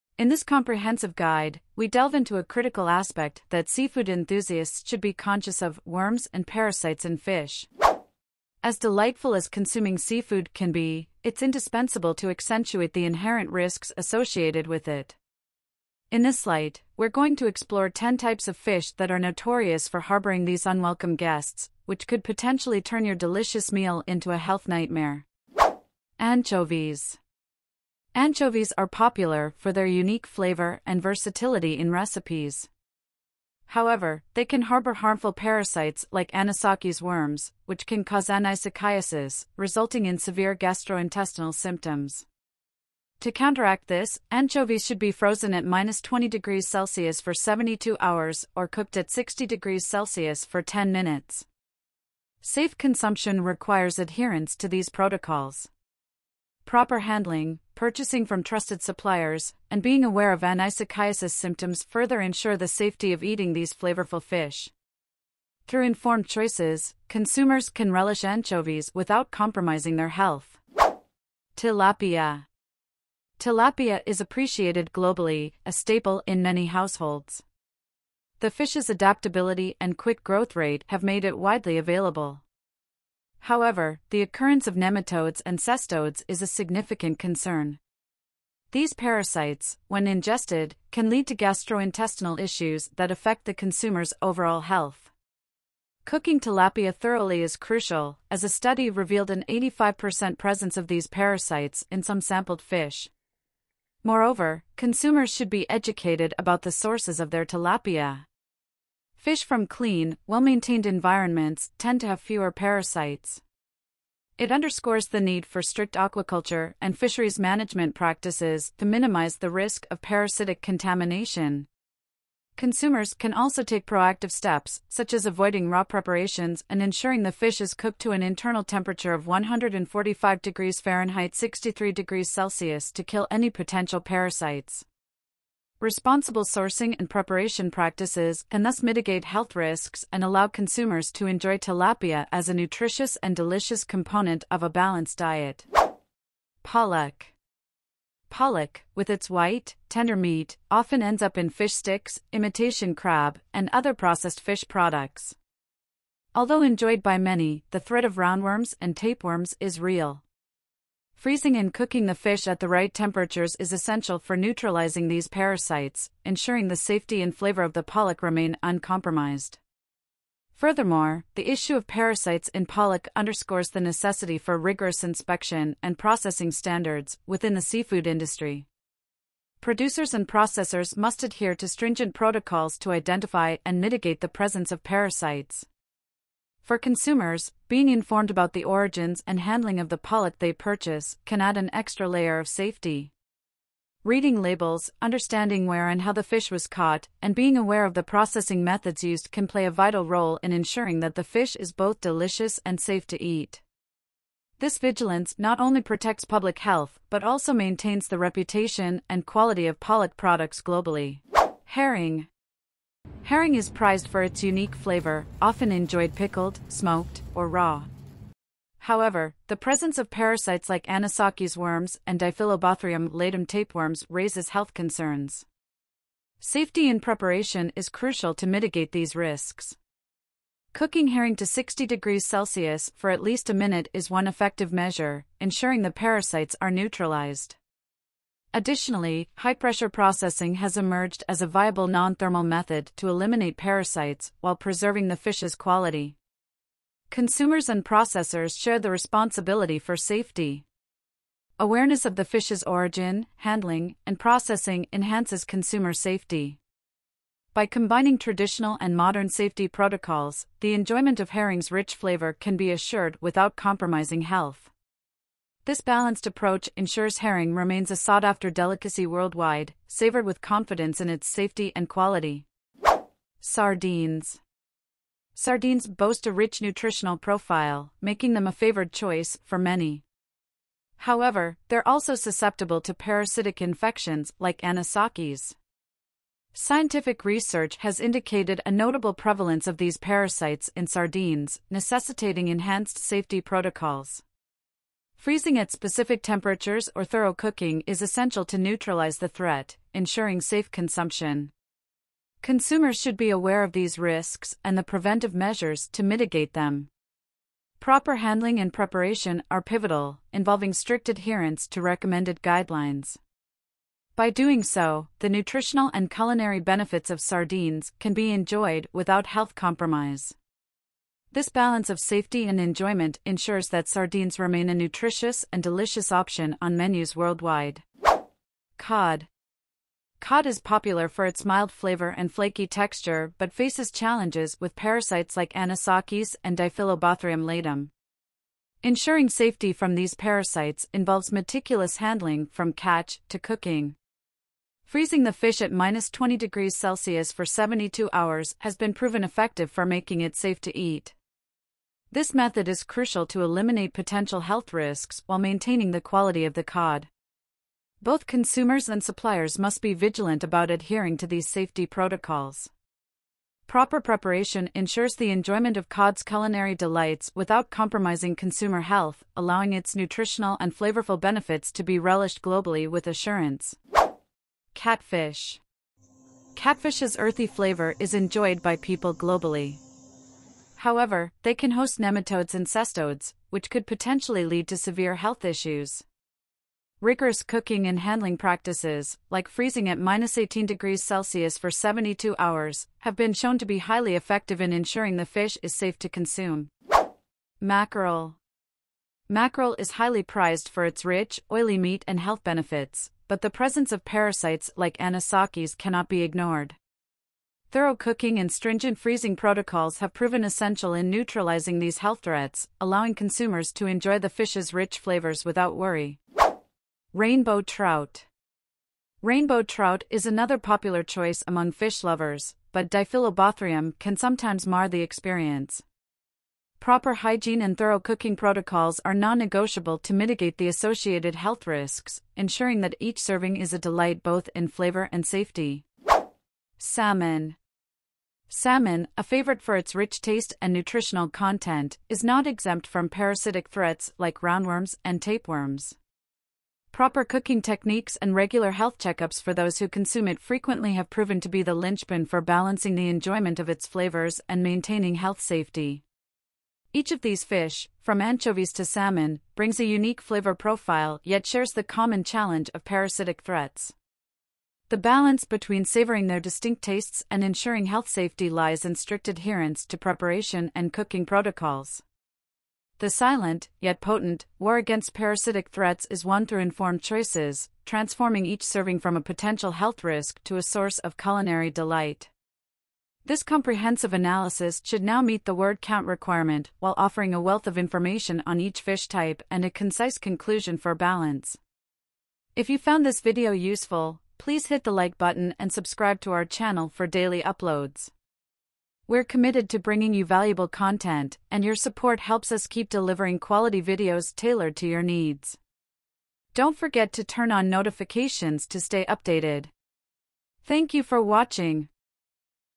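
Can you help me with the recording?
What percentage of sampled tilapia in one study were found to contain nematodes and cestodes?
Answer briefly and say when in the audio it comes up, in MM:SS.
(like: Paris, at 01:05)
85%, at 01:39.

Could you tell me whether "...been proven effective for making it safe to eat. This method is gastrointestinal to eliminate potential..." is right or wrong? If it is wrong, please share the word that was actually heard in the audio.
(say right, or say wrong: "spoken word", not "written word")
wrong: "crucial", not "gastrointestinal".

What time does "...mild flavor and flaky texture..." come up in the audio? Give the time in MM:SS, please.
05:31.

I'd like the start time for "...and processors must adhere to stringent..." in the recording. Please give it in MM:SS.
03:00.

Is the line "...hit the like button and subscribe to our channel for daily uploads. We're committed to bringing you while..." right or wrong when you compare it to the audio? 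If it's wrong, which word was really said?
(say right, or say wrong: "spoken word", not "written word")
wrong: "valuable", not "while".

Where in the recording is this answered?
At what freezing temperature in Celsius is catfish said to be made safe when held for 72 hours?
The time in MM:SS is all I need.
06:29.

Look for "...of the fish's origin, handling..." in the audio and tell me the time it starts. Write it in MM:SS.
04:12.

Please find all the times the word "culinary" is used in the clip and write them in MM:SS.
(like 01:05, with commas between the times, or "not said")
05:16, 06:06, 08:01.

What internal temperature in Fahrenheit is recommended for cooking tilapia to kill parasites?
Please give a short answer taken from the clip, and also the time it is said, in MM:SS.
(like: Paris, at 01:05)
145 degrees Fahrenheit, at 02:09.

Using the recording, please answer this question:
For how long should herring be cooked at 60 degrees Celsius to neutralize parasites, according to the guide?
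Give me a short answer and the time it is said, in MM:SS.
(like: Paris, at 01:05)
at least a minute, at 03:53.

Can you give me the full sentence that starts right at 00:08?
As delightful as consuming seafood can be, it's indispensable to accentuate the inherent risks associated with it.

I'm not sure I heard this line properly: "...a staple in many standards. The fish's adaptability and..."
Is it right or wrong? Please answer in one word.
wrong.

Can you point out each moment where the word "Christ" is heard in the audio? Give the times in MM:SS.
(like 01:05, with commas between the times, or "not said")
not said.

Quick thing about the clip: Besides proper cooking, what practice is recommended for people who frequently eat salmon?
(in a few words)
regular health checkups.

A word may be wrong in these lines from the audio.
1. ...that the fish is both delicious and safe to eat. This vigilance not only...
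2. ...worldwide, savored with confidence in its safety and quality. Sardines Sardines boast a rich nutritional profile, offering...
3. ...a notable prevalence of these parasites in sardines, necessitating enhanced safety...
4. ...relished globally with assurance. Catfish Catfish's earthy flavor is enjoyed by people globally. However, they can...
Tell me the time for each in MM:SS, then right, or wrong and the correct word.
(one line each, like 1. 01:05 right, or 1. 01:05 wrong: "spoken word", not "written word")
1. 03:21 right
2. 04:29 wrong: "making", not "offering"
3. 04:48 right
4. 06:11 right.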